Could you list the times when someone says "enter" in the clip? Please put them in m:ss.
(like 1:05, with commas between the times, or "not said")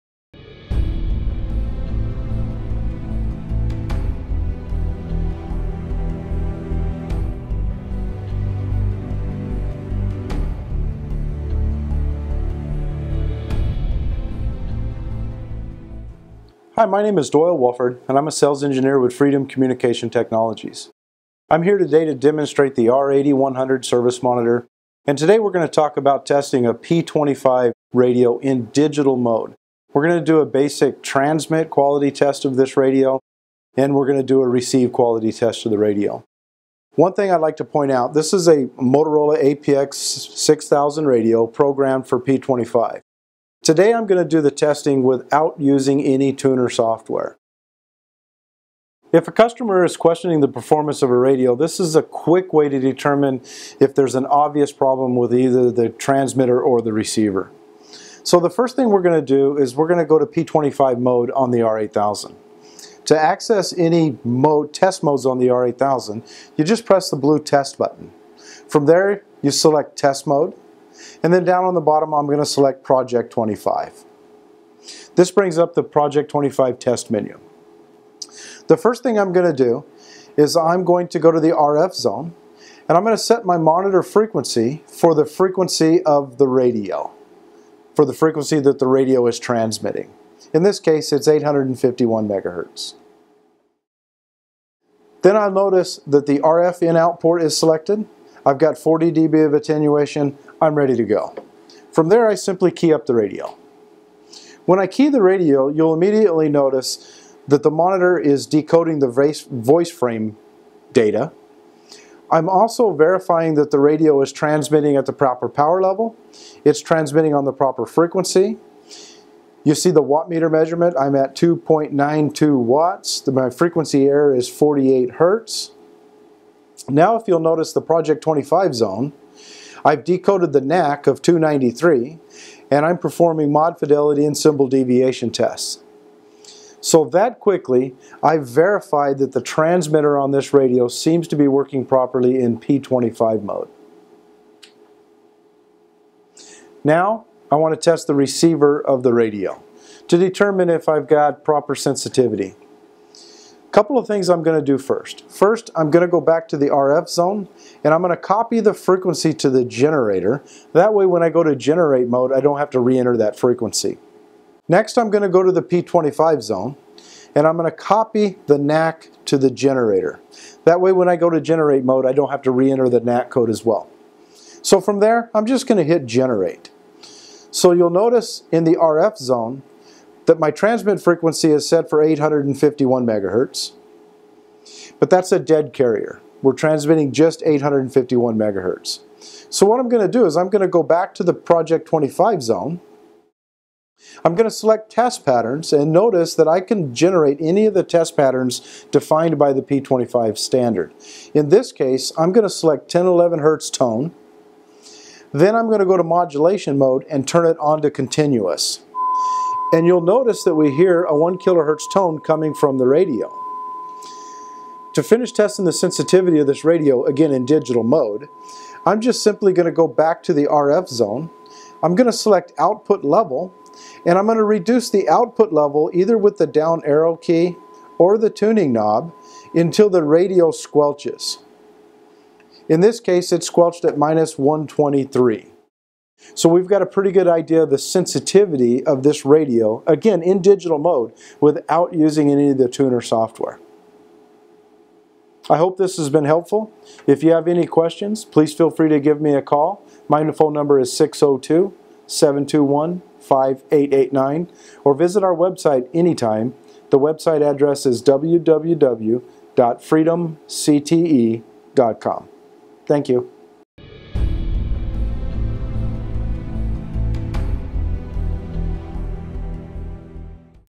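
2:42, 2:52.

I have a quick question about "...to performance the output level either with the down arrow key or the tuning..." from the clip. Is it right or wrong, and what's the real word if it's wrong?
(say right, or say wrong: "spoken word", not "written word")
wrong: "reduce", not "performance".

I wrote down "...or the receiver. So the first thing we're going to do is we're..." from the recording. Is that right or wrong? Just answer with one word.
right.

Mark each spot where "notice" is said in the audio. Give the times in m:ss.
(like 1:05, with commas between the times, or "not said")
1:35, 1:46, 2:07, 2:57, 3:15, 3:30.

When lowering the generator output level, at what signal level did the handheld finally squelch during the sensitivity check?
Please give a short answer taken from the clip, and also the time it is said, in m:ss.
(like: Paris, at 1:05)
-123, at 3:53.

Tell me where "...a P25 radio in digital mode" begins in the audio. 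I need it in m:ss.
0:26.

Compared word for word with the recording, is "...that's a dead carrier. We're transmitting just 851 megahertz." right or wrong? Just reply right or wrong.
right.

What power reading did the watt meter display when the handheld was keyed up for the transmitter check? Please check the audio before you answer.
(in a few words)
2.92 watts.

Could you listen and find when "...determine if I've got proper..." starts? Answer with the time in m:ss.
2:30.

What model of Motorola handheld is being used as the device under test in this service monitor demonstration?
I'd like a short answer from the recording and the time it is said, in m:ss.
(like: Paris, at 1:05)
APX 6000, at 0:39.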